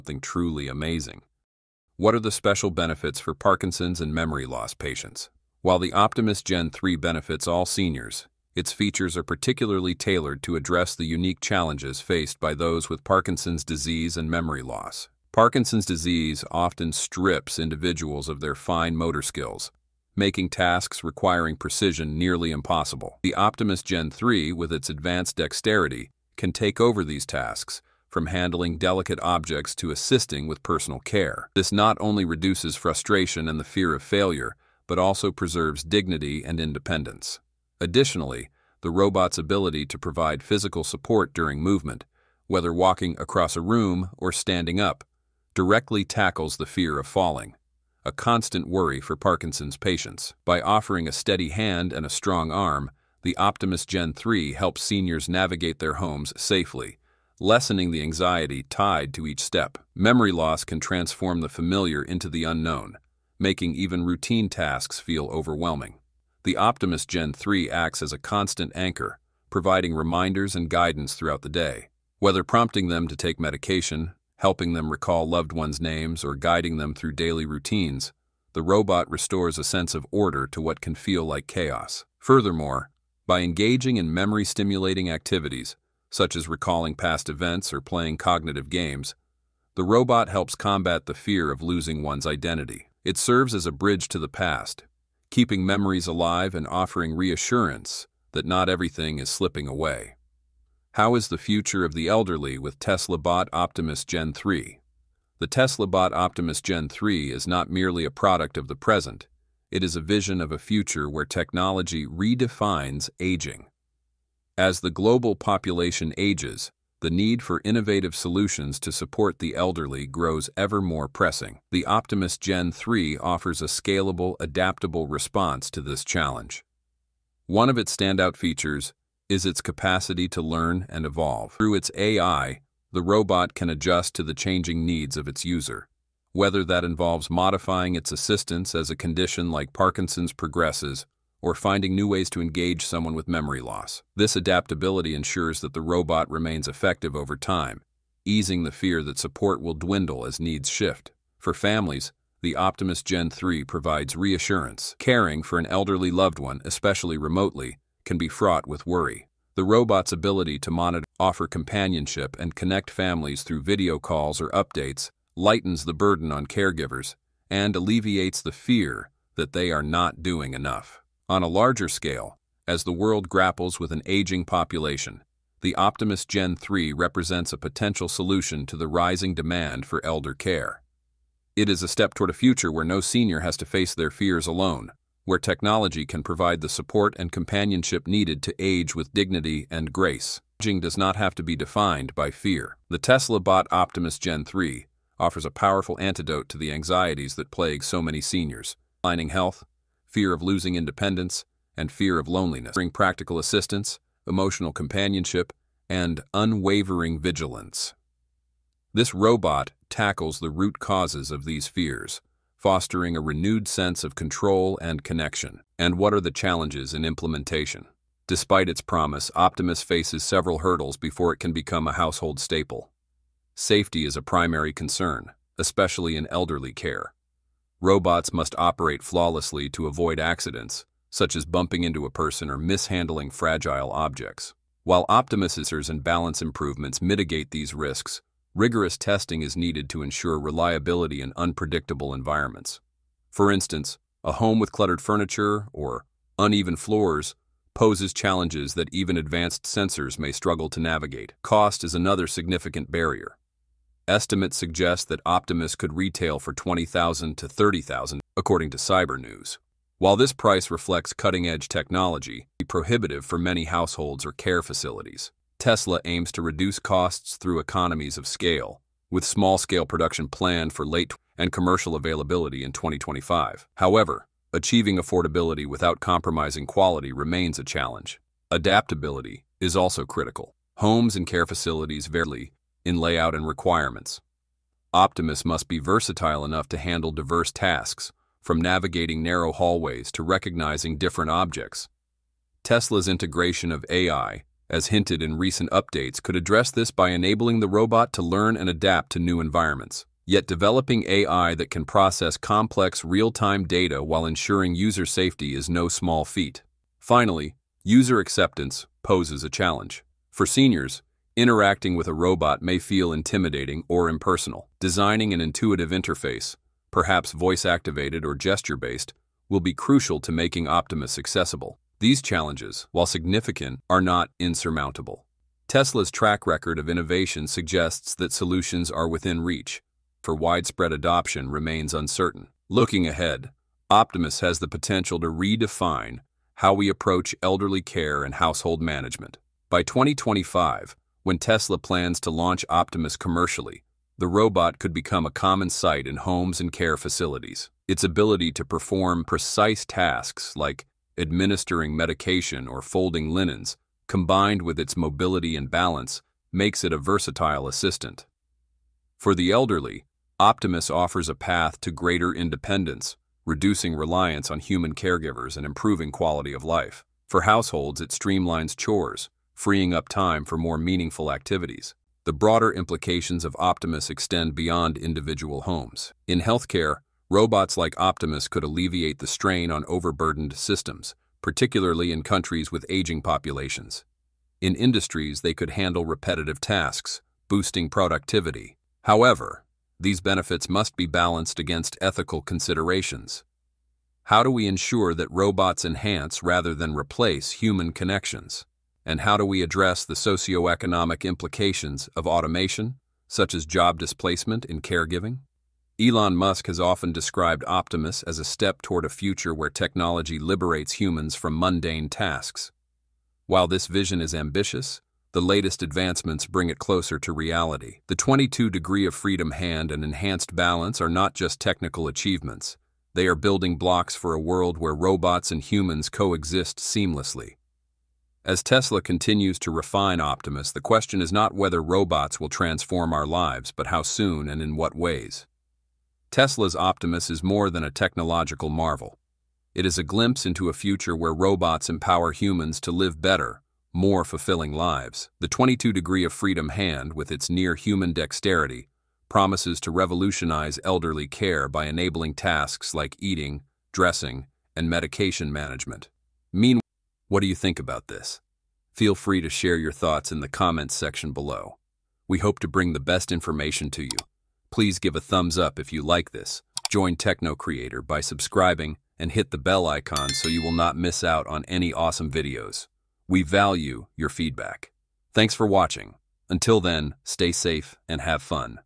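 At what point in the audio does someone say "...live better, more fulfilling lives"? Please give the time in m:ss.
7:22.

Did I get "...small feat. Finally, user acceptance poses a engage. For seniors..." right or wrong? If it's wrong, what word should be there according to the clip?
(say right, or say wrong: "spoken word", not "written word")
wrong: "challenge", not "engage".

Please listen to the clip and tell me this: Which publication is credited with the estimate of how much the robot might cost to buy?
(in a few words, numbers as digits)
Cyber News.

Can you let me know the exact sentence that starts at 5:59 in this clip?
For the elderly, Optimus offers a path to greater independence, reducing reliance on human caregivers and improving quality of life.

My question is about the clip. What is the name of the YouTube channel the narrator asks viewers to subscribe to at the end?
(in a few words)
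Techno Creator.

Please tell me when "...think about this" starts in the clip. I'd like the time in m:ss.
7:37.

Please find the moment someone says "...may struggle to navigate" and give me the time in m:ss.
4:10.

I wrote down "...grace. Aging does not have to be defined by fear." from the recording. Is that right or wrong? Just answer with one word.
right.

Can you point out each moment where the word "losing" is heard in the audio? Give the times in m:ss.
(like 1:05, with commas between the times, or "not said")
1:31, 3:20.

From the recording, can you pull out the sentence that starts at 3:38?
Despite its promise, Optimus faces several hurdles before it can become a household staple.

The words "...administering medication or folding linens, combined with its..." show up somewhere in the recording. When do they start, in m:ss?
5:51.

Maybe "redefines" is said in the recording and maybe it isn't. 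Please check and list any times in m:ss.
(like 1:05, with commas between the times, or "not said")
1:52, 5:35.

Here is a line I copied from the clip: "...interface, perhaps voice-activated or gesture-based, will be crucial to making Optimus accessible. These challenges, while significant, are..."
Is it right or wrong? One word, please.
right.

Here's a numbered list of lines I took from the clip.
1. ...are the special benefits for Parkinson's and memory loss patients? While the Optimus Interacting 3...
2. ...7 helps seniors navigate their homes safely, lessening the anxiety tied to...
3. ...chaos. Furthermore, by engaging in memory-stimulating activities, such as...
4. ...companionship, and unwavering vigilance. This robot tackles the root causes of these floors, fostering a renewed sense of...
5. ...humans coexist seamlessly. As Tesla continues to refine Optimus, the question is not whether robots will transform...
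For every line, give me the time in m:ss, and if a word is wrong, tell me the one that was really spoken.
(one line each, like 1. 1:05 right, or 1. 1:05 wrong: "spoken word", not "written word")
1. 0:02 wrong: "Gen", not "Interacting"
2. 0:54 wrong: "3", not "7"
3. 1:21 right
4. 3:24 wrong: "fears", not "floors"
5. 7:05 right.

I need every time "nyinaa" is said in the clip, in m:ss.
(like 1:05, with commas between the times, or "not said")
not said.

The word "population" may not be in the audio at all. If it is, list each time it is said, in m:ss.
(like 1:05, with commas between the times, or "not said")
1:55, 2:54, 6:23.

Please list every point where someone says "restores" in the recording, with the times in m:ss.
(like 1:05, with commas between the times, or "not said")
1:19.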